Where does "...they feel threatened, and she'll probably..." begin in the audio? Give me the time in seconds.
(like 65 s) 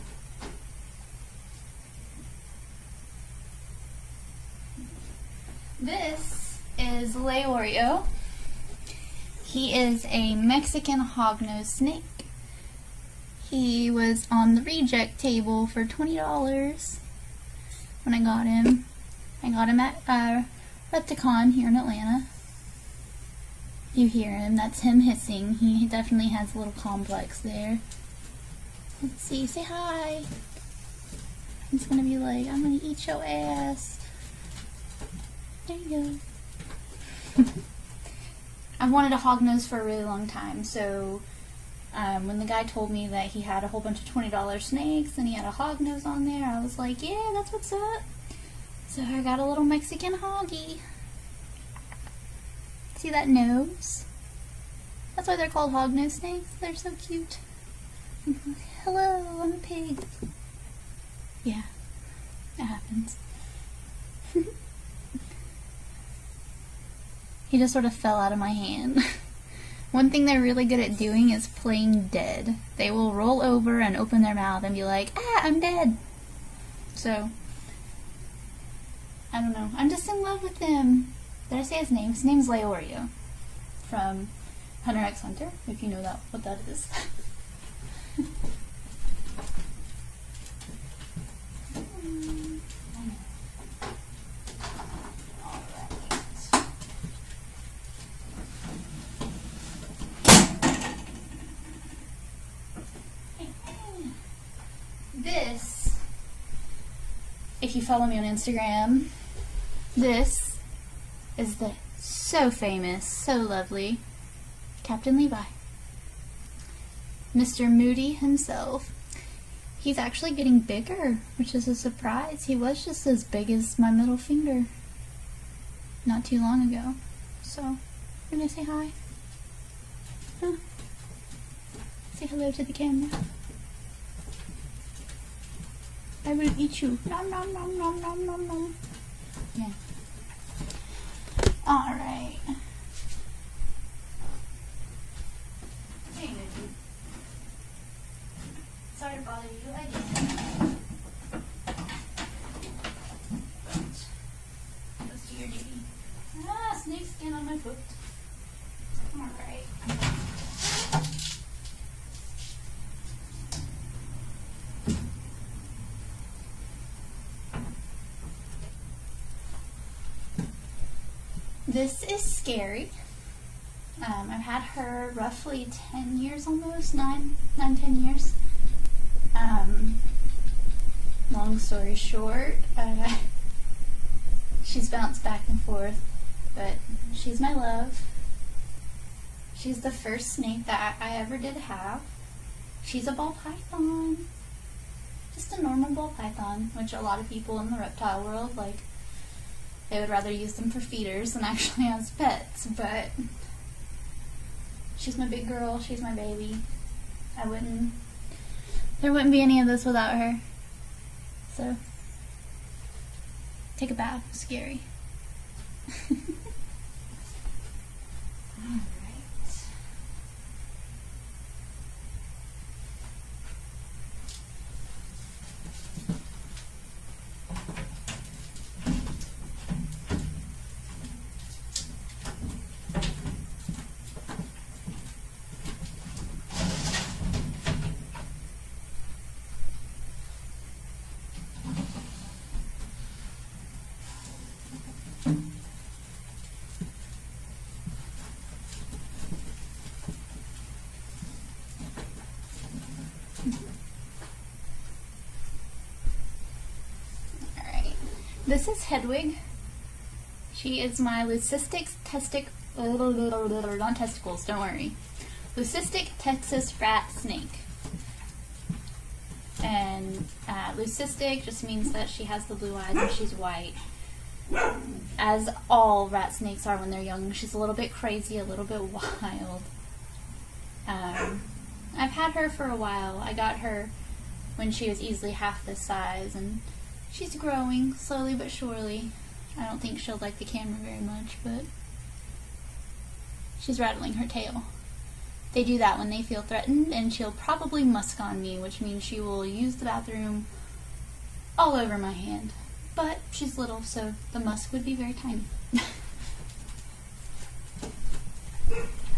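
296 s.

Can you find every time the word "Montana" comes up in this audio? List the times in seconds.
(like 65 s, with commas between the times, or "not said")
not said.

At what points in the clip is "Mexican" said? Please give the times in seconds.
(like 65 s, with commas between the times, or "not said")
10 s, 49 s.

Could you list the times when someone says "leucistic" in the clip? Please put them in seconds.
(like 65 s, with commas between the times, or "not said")
261 s, 265 s, 270 s.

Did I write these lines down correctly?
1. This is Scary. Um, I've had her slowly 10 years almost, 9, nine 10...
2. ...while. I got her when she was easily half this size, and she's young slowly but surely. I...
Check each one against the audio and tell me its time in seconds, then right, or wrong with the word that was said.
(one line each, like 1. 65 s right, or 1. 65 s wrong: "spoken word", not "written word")
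1. 171 s wrong: "roughly", not "slowly"
2. 282 s wrong: "growing", not "young".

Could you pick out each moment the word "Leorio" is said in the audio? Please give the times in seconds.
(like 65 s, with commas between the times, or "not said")
7 s, 82 s.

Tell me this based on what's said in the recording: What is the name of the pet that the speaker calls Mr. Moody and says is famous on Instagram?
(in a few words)
Captain Levi.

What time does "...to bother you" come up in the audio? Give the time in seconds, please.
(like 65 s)
149 s.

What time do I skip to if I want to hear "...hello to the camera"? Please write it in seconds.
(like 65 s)
132 s.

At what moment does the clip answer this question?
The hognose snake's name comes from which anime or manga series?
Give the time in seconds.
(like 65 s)
84 s.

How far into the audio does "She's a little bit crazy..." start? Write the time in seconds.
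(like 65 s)
277 s.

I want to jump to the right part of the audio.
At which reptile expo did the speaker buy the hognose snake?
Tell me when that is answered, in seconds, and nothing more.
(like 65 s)
20 s.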